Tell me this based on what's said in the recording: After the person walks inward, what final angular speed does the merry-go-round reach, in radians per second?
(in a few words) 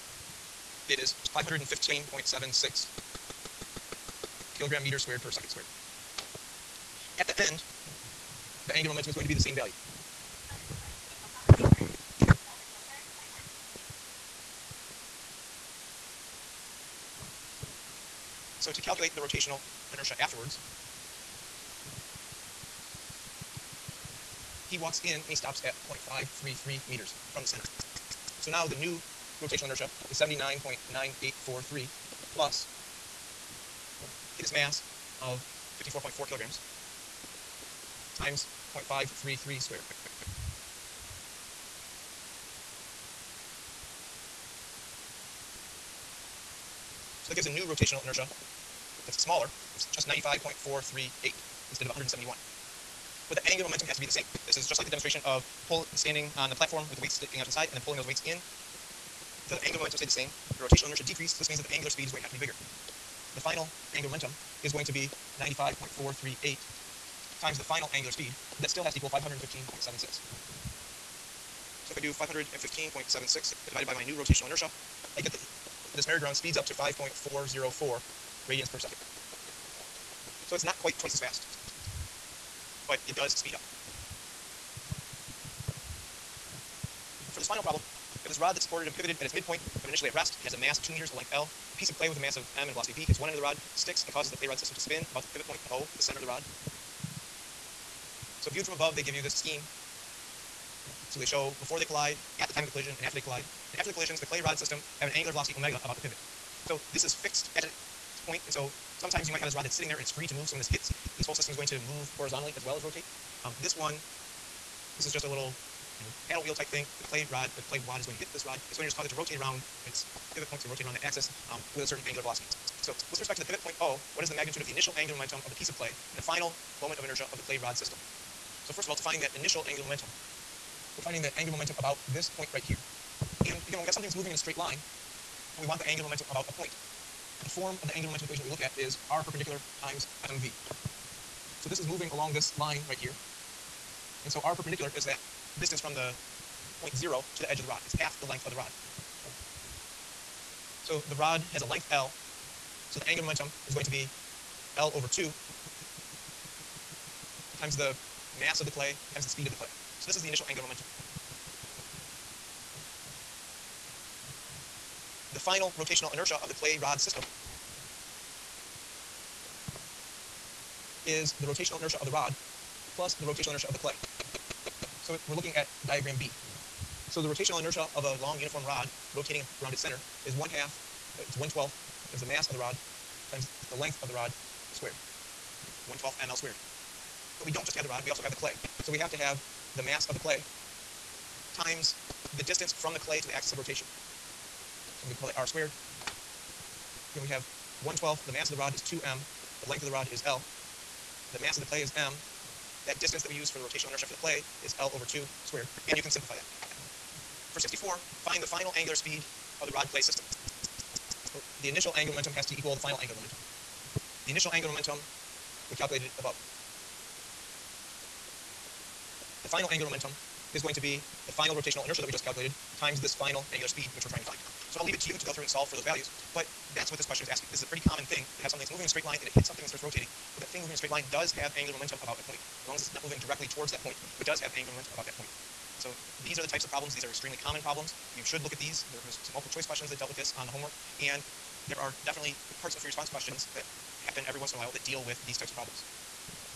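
5.404 radians per second.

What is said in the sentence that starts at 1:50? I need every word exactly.
So when this hits, this whole system is going to move horizontally as well as rotate.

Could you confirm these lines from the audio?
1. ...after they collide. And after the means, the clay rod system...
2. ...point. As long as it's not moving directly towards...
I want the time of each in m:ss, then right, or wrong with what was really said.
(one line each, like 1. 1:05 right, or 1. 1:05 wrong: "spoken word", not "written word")
1. 1:43 wrong: "collisions", not "means"
2. 3:52 right.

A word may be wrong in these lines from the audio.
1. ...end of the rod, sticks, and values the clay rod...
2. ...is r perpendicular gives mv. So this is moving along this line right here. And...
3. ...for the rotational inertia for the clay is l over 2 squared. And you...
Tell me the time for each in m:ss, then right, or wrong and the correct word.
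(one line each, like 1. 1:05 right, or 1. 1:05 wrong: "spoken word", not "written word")
1. 1:33 wrong: "causes", not "values"
2. 2:18 wrong: "times", not "gives"
3. 3:23 right.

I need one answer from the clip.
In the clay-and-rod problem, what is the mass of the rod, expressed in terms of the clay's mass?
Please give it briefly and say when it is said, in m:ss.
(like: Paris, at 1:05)
2m, at 3:18.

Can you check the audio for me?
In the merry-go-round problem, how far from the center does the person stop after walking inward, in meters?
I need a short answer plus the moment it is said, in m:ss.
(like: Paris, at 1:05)
0.533 meters, at 0:26.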